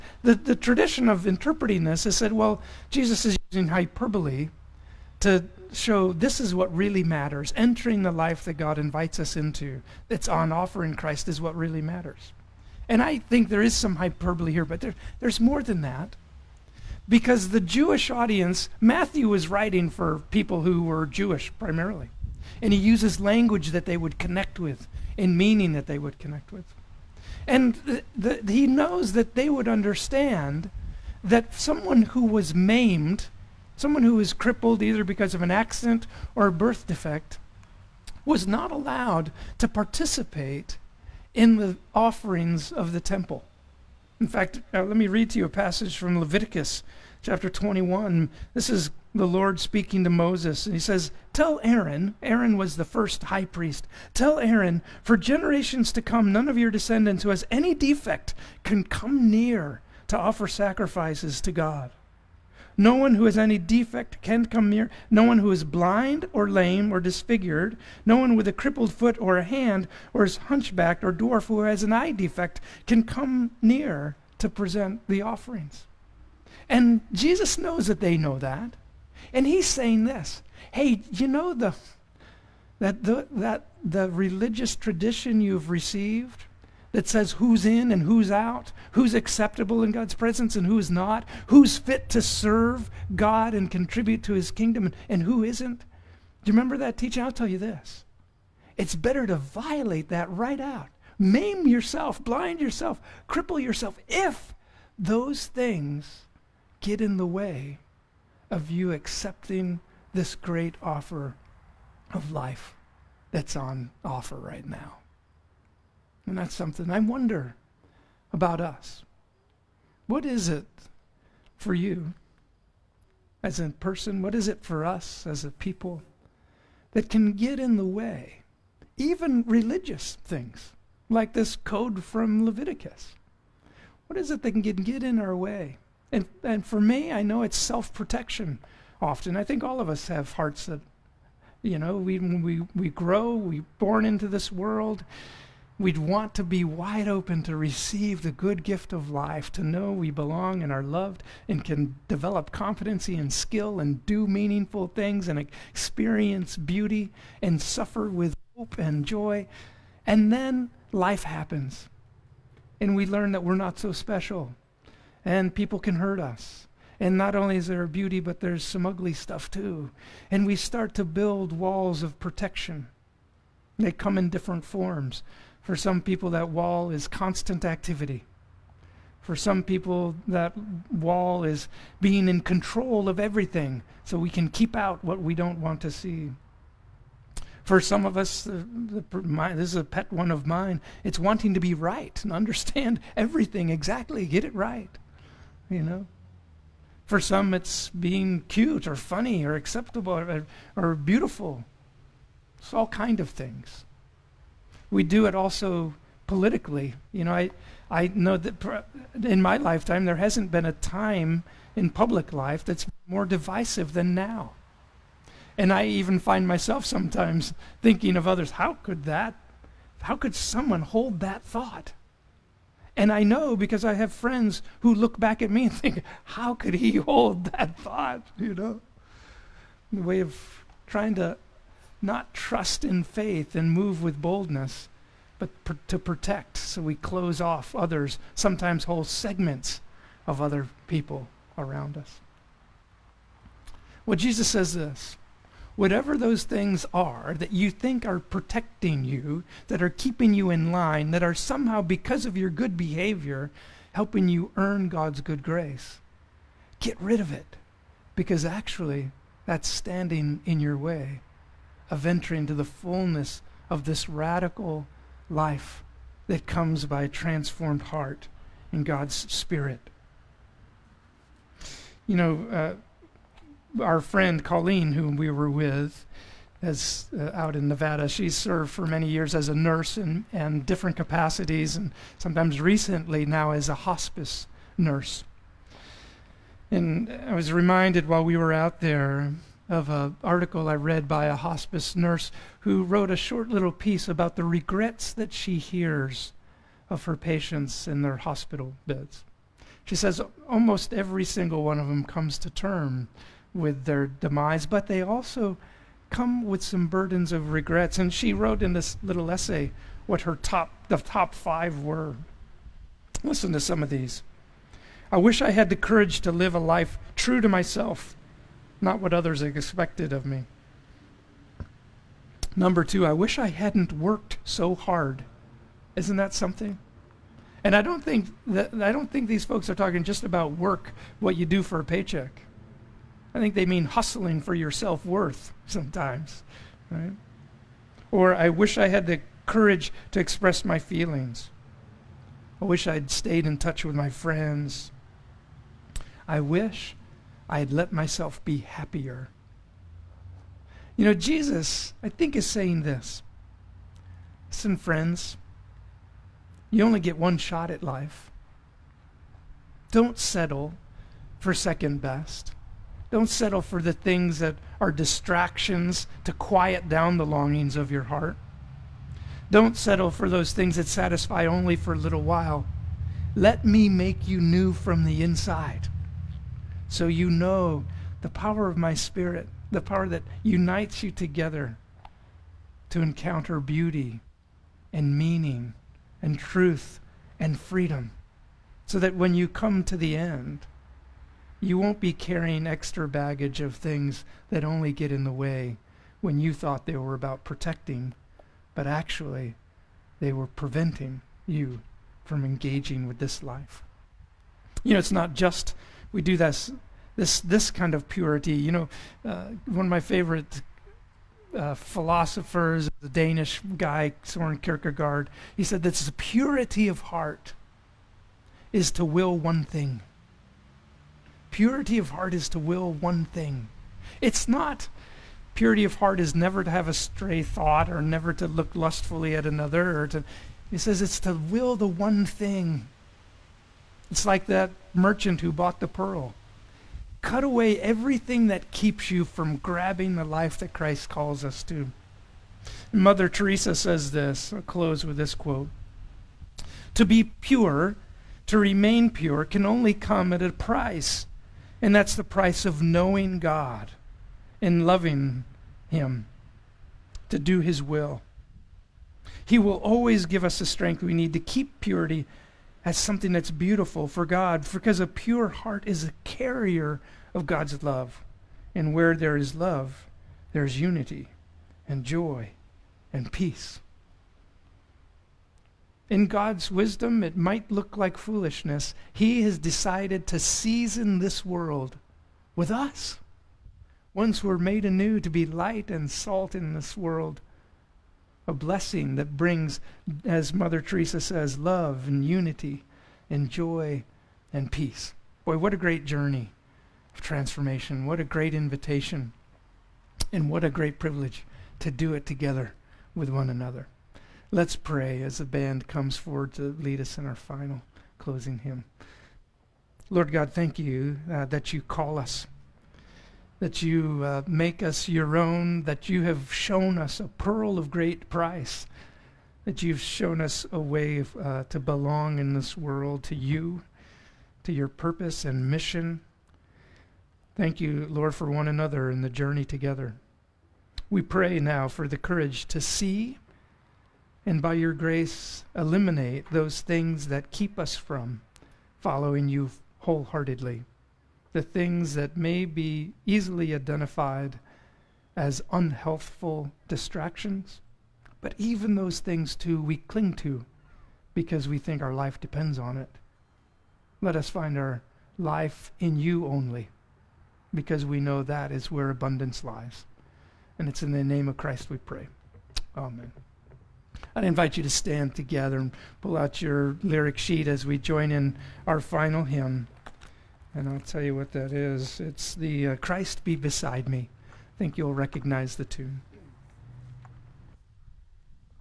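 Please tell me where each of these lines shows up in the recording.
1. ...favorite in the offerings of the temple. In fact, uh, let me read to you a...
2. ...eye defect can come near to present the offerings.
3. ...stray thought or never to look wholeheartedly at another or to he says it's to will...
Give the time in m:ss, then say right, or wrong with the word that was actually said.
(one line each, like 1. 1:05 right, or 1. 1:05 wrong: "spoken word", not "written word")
1. 0:39 wrong: "participate", not "favorite"
2. 1:11 right
3. 7:06 wrong: "lustfully", not "wholeheartedly".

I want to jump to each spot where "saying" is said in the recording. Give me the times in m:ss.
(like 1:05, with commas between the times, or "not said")
1:19, 5:52.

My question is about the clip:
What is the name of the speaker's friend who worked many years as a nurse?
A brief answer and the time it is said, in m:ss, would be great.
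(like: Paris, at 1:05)
Colleen, at 4:34.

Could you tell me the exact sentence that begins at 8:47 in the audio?
Thank you, Lord, for one another and the journey together.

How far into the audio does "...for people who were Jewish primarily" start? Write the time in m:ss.
0:19.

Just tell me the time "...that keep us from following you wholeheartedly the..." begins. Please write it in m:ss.
8:57.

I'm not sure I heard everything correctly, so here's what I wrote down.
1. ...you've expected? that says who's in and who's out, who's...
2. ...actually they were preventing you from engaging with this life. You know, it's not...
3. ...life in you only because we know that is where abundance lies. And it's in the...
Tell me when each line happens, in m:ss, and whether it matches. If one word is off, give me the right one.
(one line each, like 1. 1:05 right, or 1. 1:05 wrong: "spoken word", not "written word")
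1. 1:25 wrong: "received", not "expected"
2. 6:38 right
3. 9:15 right.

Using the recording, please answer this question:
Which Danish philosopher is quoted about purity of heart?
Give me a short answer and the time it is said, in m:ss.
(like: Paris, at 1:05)
Soren Kierkegaard, at 6:54.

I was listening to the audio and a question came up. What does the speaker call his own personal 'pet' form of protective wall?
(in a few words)
wanting to be right.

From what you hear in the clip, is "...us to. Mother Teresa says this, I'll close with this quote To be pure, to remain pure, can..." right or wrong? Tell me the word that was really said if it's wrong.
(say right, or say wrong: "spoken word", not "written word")
right.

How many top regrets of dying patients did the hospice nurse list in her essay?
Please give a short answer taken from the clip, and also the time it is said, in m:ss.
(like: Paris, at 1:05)
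5, at 5:11.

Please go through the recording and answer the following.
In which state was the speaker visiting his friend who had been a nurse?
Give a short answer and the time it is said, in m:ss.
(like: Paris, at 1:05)
Nevada, at 4:37.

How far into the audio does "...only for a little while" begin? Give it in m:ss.
6:11.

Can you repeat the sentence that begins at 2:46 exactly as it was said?
And not only is there beauty, but there's some ugly stuff too.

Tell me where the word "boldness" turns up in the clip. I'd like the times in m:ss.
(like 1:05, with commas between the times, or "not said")
3:54.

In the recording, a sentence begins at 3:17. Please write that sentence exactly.
For some, it's being cute or funny or acceptable or, or beautiful.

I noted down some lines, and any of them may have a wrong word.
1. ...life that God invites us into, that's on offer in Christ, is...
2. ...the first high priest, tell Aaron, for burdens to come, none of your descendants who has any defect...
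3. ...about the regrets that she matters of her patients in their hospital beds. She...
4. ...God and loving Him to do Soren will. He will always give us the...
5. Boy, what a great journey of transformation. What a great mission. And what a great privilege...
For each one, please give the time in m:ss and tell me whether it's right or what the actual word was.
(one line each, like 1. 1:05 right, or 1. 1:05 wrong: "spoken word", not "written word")
1. 0:08 right
2. 0:52 wrong: "generations", not "burdens"
3. 4:54 wrong: "hears", not "matters"
4. 7:33 wrong: "His", not "Soren"
5. 8:15 wrong: "invitation", not "mission".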